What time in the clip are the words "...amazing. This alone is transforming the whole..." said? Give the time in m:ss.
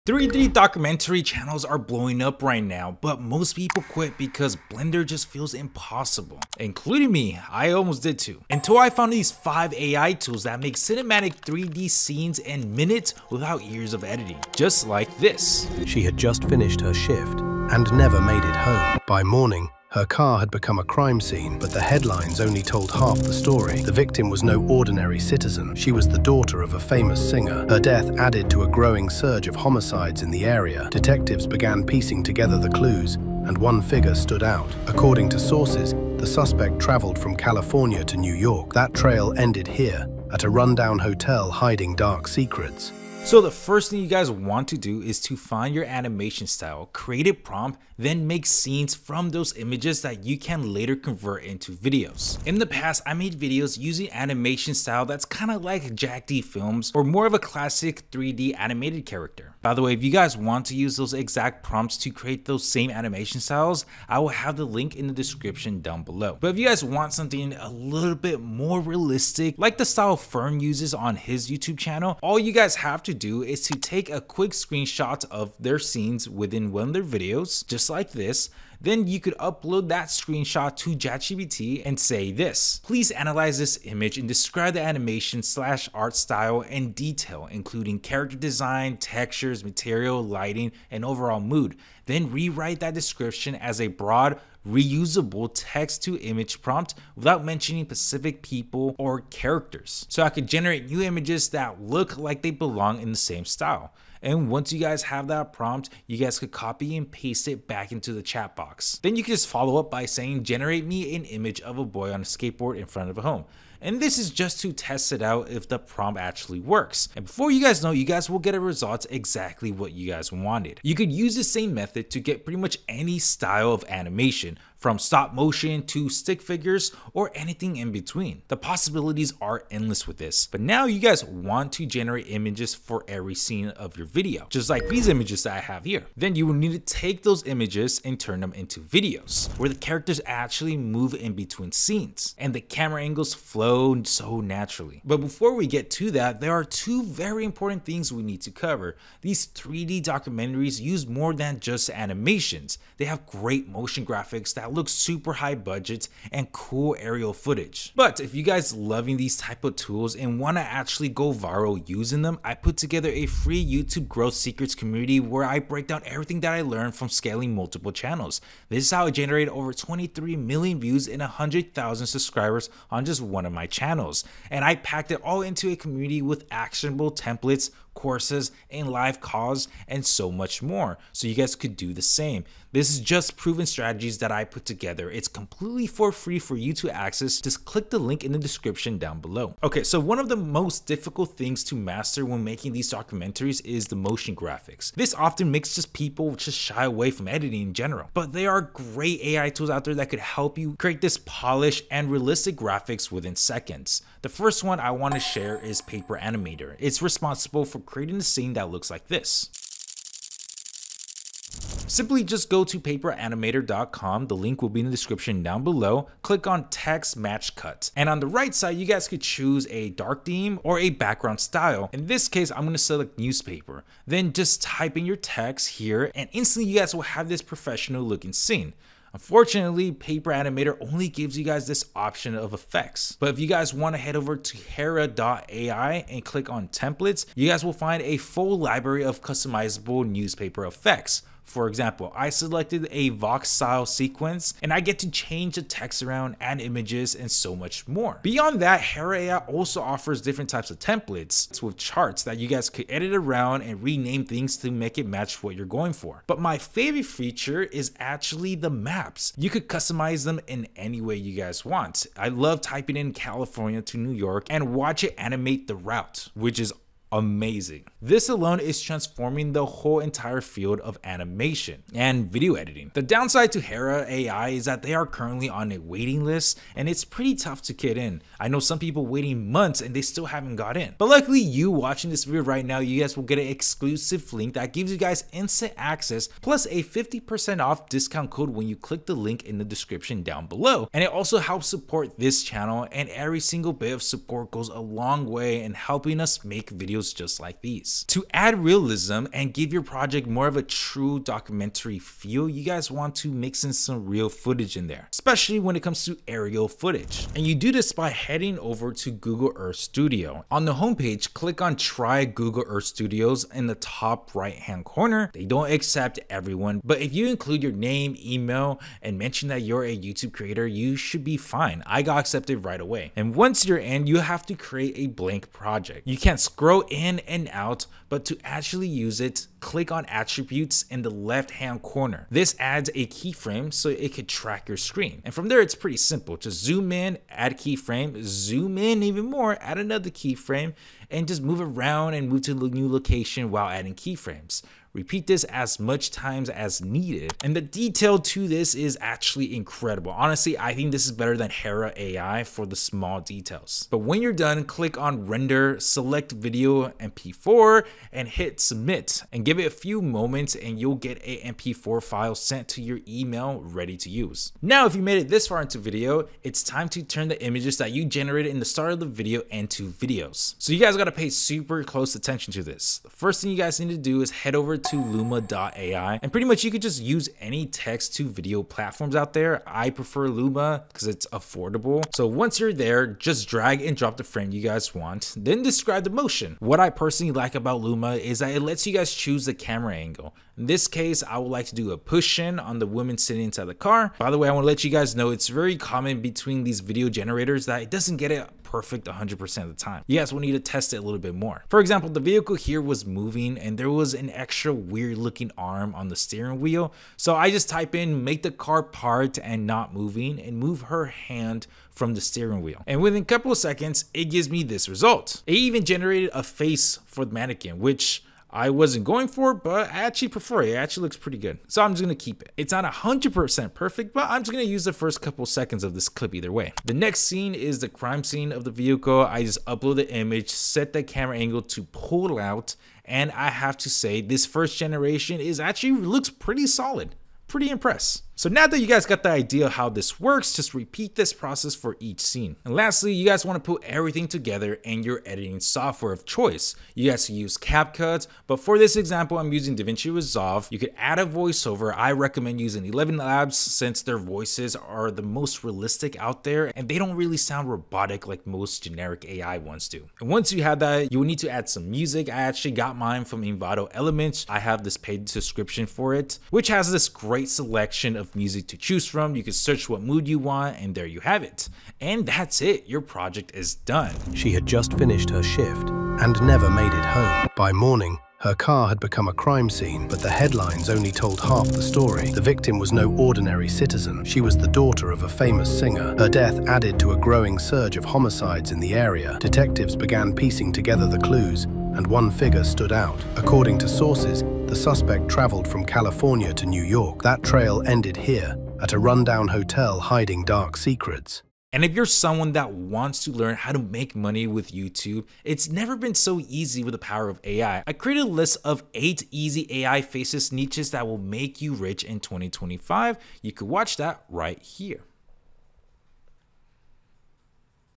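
4:27.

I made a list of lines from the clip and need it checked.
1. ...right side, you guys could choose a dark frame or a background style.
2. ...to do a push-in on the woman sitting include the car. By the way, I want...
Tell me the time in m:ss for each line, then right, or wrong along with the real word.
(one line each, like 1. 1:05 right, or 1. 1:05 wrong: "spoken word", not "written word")
1. 3:38 wrong: "theme", not "frame"
2. 6:31 wrong: "inside", not "include".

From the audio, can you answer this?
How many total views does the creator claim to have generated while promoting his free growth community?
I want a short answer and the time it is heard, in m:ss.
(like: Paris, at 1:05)
23 million, at 2:49.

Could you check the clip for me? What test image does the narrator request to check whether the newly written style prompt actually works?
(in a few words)
A boy on a skateboard.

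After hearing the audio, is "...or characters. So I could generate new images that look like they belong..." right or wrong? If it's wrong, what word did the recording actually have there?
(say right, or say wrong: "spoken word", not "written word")
right.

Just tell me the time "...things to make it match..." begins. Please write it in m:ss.
4:14.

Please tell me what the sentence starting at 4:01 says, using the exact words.
For example, I selected a Vox style sequence and I get to change the text around, and images, and so much more.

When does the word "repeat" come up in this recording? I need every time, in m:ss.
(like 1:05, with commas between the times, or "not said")
5:44, 7:20.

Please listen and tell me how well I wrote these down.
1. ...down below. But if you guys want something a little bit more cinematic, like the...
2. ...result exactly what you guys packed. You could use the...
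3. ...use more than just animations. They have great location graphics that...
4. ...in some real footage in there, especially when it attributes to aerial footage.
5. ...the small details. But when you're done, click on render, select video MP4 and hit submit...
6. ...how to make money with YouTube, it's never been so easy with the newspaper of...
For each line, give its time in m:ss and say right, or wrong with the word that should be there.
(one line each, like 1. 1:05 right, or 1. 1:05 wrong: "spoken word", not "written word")
1. 1:05 wrong: "realistic", not "cinematic"
2. 1:58 wrong: "wanted", not "packed"
3. 2:30 wrong: "motion", not "location"
4. 5:03 wrong: "comes", not "attributes"
5. 5:52 right
6. 8:23 wrong: "power", not "newspaper".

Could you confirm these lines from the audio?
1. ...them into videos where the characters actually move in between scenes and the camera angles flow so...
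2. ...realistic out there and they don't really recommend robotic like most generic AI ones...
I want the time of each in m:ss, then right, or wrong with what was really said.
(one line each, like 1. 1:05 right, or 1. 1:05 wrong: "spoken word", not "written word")
1. 2:18 right
2. 7:35 wrong: "sound", not "recommend".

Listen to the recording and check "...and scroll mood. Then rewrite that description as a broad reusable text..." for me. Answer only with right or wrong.
wrong.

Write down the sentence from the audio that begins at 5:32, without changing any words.
This adds a keyframe so it could track your screen.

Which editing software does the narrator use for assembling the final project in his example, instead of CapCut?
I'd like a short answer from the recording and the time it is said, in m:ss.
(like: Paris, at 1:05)
DaVinci Resolve, at 7:29.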